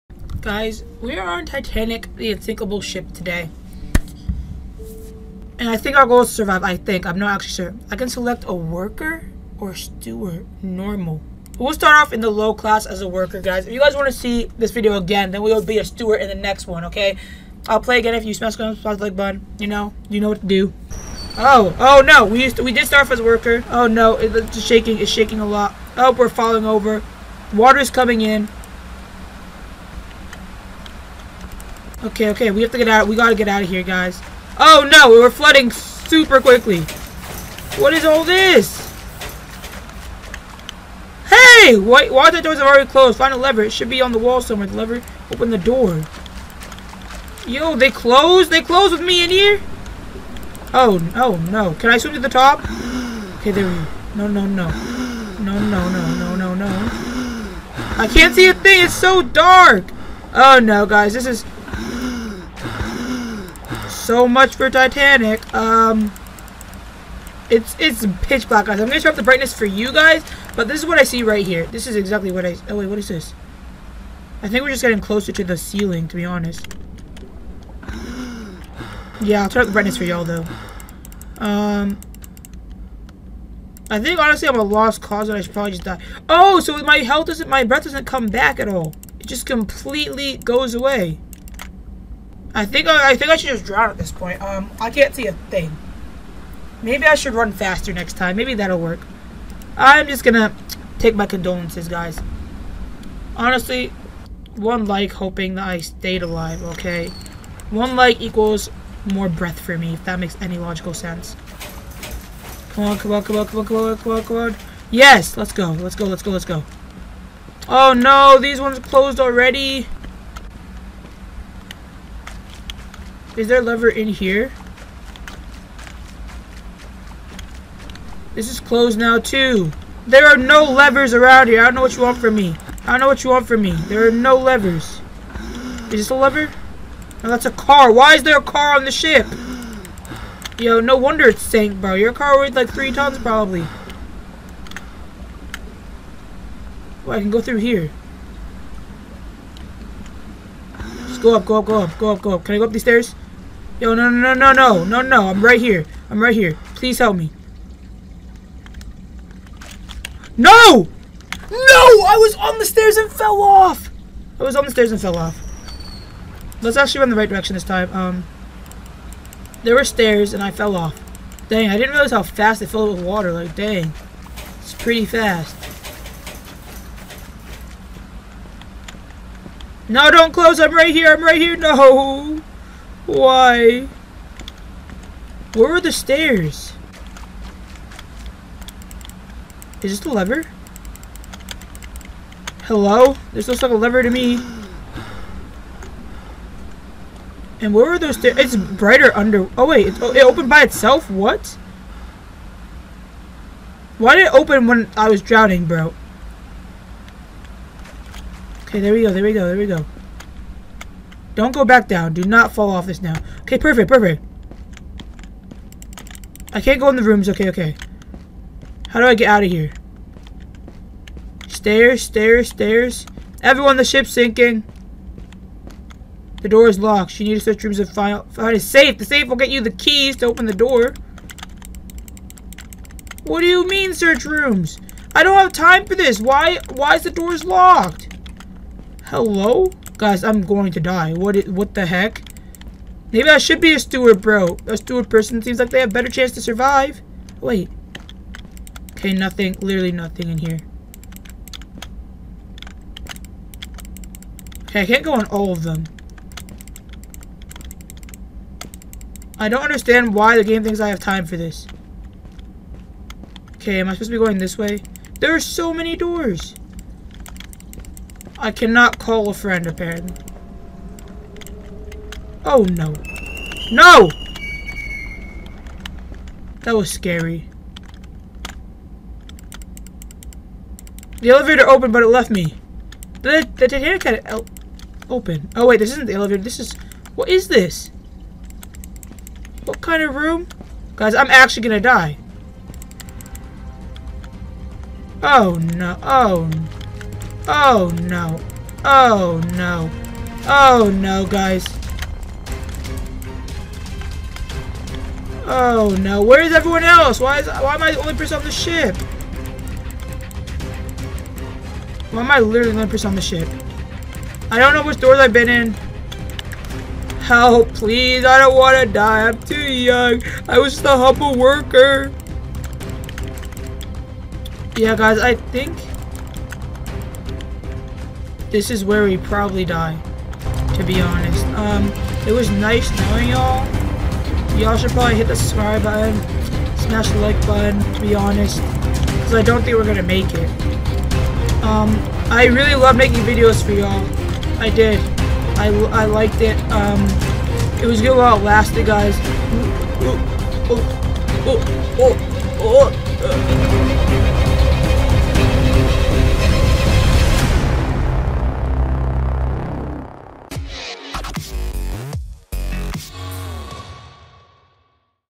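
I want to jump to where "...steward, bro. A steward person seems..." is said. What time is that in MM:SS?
04:03.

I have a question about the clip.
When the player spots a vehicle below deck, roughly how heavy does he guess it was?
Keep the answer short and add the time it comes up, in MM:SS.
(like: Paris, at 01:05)
three tons, at 02:22.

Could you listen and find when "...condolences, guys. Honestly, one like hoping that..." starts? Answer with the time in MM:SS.
01:41.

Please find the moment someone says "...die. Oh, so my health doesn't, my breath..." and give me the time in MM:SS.
01:25.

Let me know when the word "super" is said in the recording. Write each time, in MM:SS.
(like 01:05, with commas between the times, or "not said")
00:35.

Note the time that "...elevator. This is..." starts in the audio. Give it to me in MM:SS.
04:46.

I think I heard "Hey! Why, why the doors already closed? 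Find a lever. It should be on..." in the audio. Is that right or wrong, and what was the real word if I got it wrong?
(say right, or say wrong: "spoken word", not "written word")
right.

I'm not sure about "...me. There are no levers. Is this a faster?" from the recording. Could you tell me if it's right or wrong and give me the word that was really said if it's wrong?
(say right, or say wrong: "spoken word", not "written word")
wrong: "lever", not "faster".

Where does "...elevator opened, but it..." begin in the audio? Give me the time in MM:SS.
04:41.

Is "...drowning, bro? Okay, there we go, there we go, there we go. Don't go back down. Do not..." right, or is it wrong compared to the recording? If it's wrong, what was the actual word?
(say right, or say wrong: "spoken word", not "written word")
right.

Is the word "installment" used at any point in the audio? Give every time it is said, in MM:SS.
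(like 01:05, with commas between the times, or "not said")
not said.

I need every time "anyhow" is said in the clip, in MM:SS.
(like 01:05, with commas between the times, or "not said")
not said.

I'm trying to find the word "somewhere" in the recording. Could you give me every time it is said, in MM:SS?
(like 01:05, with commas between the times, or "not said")
00:44.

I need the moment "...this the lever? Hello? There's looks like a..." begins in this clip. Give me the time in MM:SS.
03:09.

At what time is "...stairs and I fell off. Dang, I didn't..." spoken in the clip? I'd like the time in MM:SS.
02:49.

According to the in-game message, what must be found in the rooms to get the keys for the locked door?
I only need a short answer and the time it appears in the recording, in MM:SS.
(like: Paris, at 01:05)
A safe, at 03:48.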